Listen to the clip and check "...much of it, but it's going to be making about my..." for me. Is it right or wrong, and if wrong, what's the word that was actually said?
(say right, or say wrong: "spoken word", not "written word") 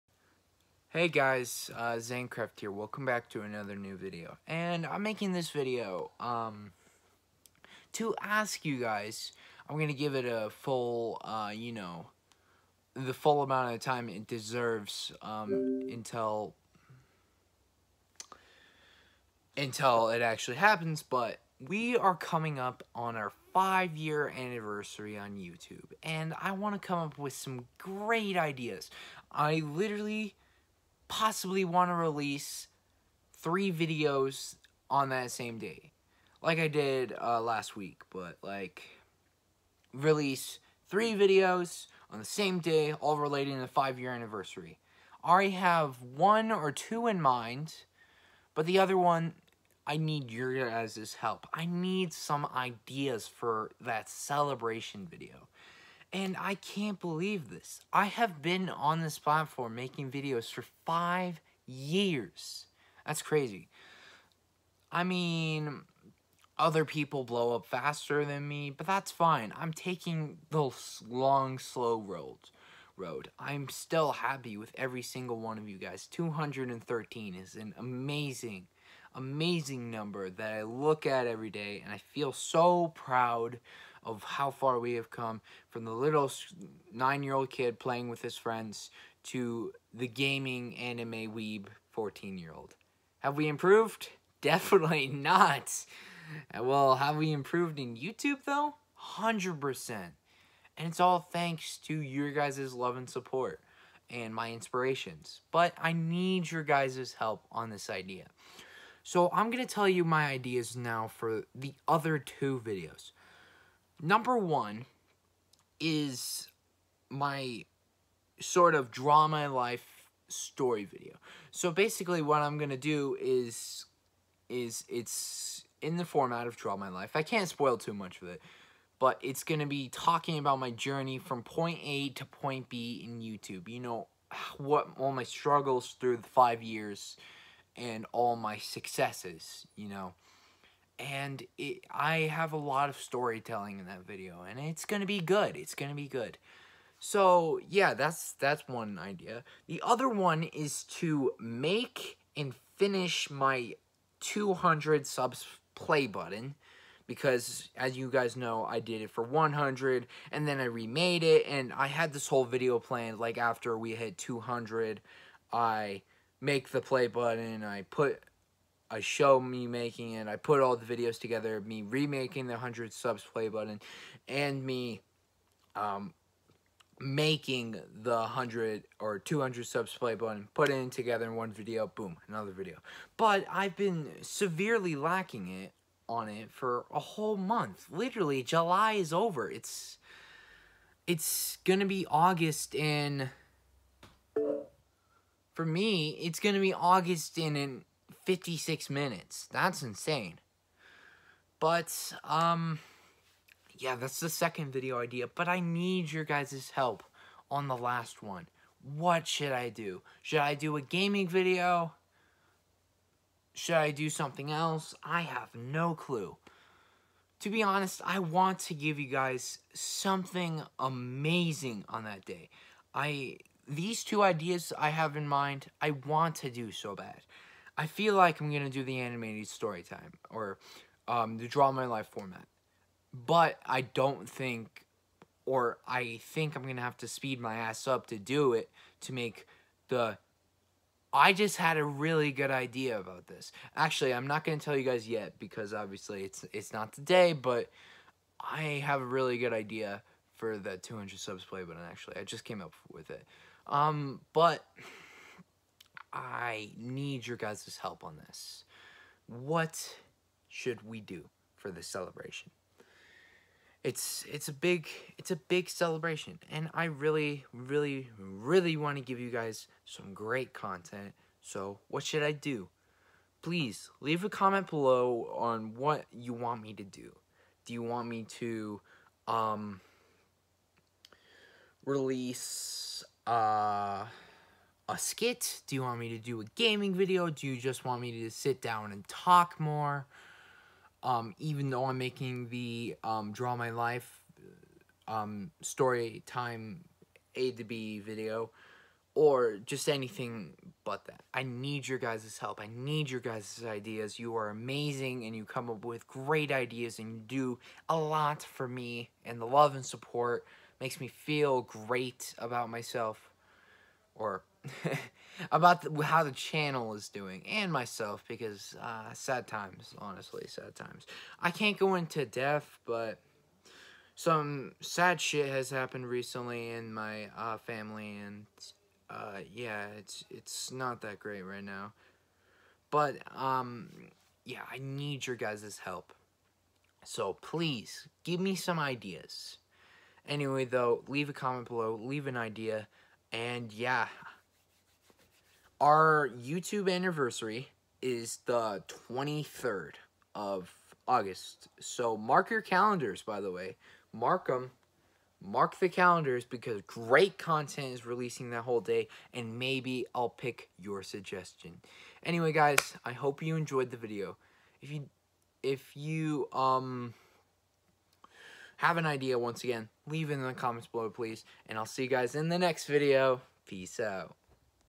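wrong: "talking", not "making".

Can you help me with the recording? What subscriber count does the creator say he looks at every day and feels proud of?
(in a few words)
213.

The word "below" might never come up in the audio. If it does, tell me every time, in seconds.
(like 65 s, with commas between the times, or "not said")
274 s, 341 s, 370 s.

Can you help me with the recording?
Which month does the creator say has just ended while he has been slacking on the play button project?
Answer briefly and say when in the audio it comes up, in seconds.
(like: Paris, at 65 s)
July, at 188 s.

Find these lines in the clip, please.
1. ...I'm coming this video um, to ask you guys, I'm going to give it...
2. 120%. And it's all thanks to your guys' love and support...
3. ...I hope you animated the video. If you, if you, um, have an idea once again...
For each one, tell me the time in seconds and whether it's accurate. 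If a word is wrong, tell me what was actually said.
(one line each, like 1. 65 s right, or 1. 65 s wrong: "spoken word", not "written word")
1. 4 s wrong: "making", not "coming"
2. 99 s wrong: "100", not "120"
3. 363 s wrong: "enjoyed", not "animated".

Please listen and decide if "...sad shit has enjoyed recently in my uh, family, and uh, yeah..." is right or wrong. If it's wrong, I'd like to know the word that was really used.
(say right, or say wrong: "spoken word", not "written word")
wrong: "happened", not "enjoyed".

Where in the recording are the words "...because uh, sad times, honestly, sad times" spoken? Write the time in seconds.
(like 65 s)
318 s.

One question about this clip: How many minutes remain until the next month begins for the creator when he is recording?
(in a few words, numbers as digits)
56.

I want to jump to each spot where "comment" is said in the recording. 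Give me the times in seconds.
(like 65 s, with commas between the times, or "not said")
274 s, 341 s, 370 s.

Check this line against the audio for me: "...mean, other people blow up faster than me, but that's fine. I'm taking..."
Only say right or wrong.
right.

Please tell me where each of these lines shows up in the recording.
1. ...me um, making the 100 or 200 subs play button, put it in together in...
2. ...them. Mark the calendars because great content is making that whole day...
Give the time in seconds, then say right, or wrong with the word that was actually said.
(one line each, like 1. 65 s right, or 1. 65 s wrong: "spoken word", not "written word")
1. 174 s right
2. 354 s wrong: "releasing", not "making".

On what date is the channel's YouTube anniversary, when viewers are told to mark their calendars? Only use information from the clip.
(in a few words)
23rd of August.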